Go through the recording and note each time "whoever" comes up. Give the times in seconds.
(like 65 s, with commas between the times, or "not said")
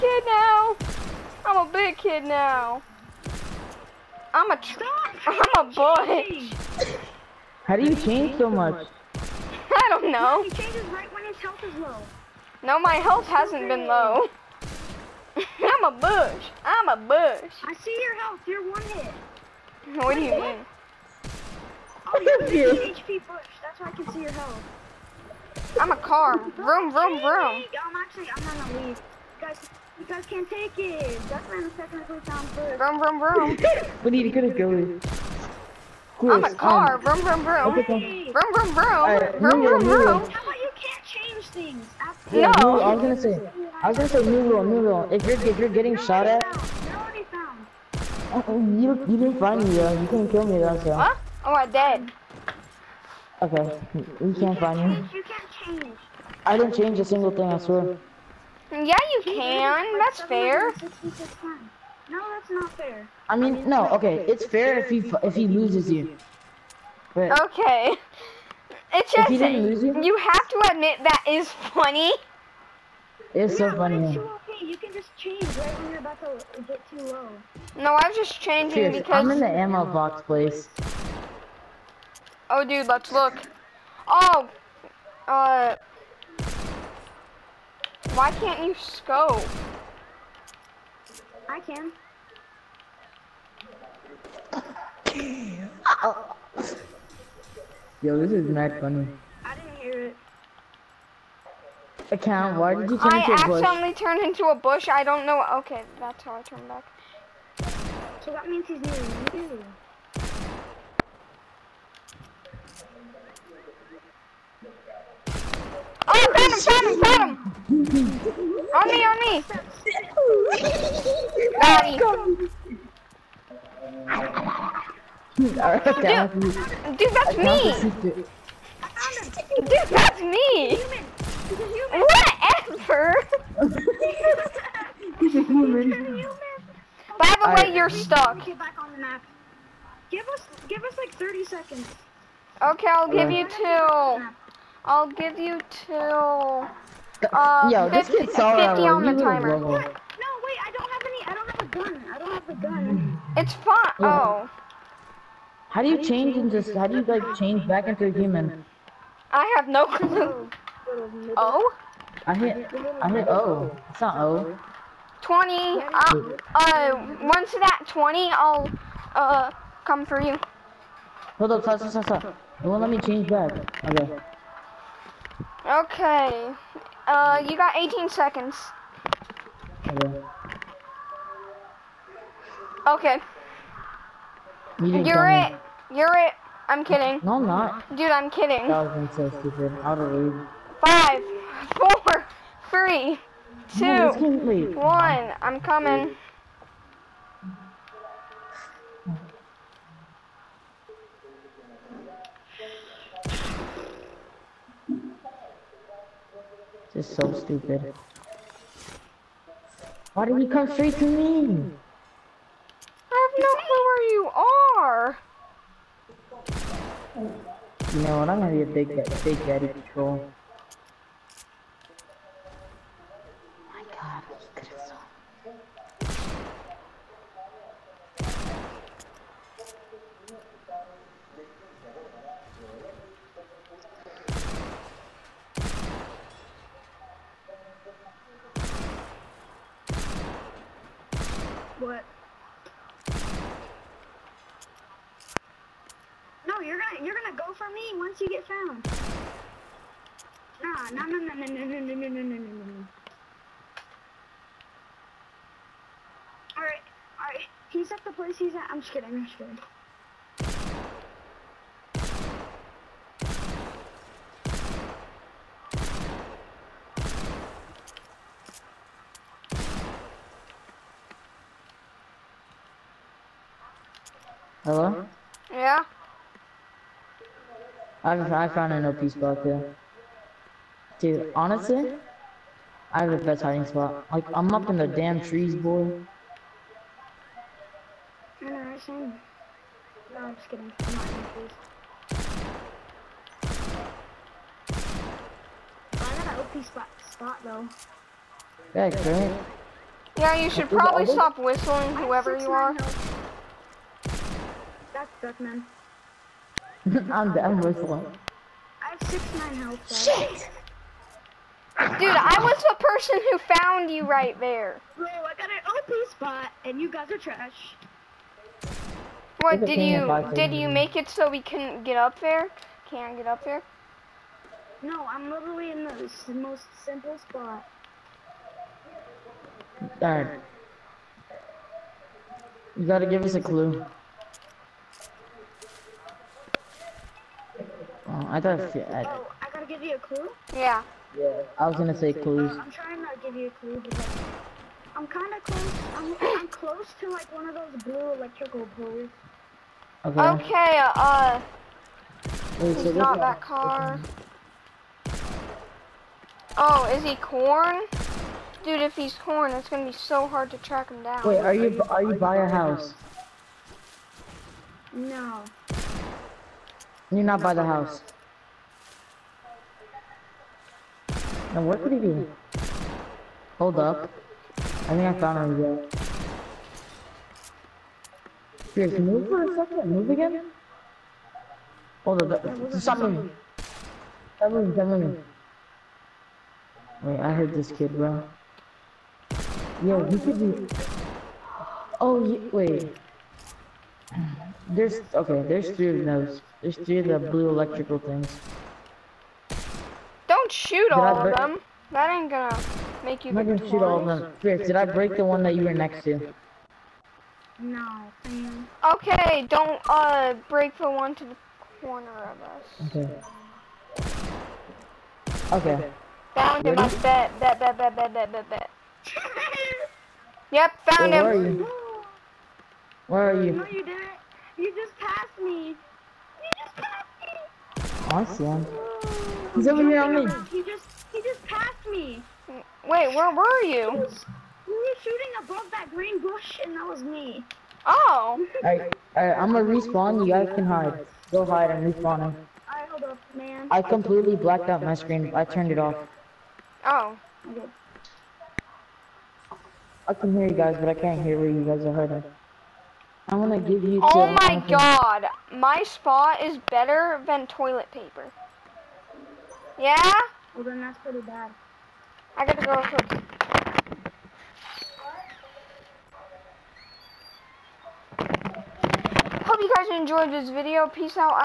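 301 s.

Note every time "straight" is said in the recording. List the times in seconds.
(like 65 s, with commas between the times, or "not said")
210 s.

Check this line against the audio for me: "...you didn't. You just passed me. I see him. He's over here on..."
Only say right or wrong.
right.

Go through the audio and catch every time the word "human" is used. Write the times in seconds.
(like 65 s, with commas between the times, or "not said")
135 s, 158 s.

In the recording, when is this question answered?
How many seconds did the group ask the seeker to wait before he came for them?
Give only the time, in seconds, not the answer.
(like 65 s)
141 s.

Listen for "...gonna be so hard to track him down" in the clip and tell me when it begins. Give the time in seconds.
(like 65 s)
359 s.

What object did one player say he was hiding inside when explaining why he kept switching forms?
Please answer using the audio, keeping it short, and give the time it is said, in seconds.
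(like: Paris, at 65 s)
ammo box, at 79 s.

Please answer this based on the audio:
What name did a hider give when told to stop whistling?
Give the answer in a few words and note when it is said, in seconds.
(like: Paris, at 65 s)
Duckman, at 305 s.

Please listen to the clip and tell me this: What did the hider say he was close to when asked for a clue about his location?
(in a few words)
blue electrical poles.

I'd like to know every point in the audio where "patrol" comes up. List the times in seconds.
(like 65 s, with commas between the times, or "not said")
219 s.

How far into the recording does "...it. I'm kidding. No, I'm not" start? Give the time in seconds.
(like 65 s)
186 s.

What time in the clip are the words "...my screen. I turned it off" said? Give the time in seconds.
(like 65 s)
444 s.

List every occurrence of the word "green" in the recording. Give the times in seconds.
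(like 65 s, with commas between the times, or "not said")
435 s.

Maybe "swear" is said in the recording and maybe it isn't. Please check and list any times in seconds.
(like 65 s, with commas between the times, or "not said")
57 s.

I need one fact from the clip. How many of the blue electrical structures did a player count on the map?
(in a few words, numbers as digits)
3.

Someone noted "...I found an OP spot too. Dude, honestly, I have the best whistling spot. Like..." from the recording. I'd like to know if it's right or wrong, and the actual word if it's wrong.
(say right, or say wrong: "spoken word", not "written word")
wrong: "hiding", not "whistling".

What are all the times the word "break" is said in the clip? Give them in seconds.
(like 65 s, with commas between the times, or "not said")
404 s, 410 s.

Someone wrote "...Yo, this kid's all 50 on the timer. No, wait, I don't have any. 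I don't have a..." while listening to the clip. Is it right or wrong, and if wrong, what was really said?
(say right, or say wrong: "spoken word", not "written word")
right.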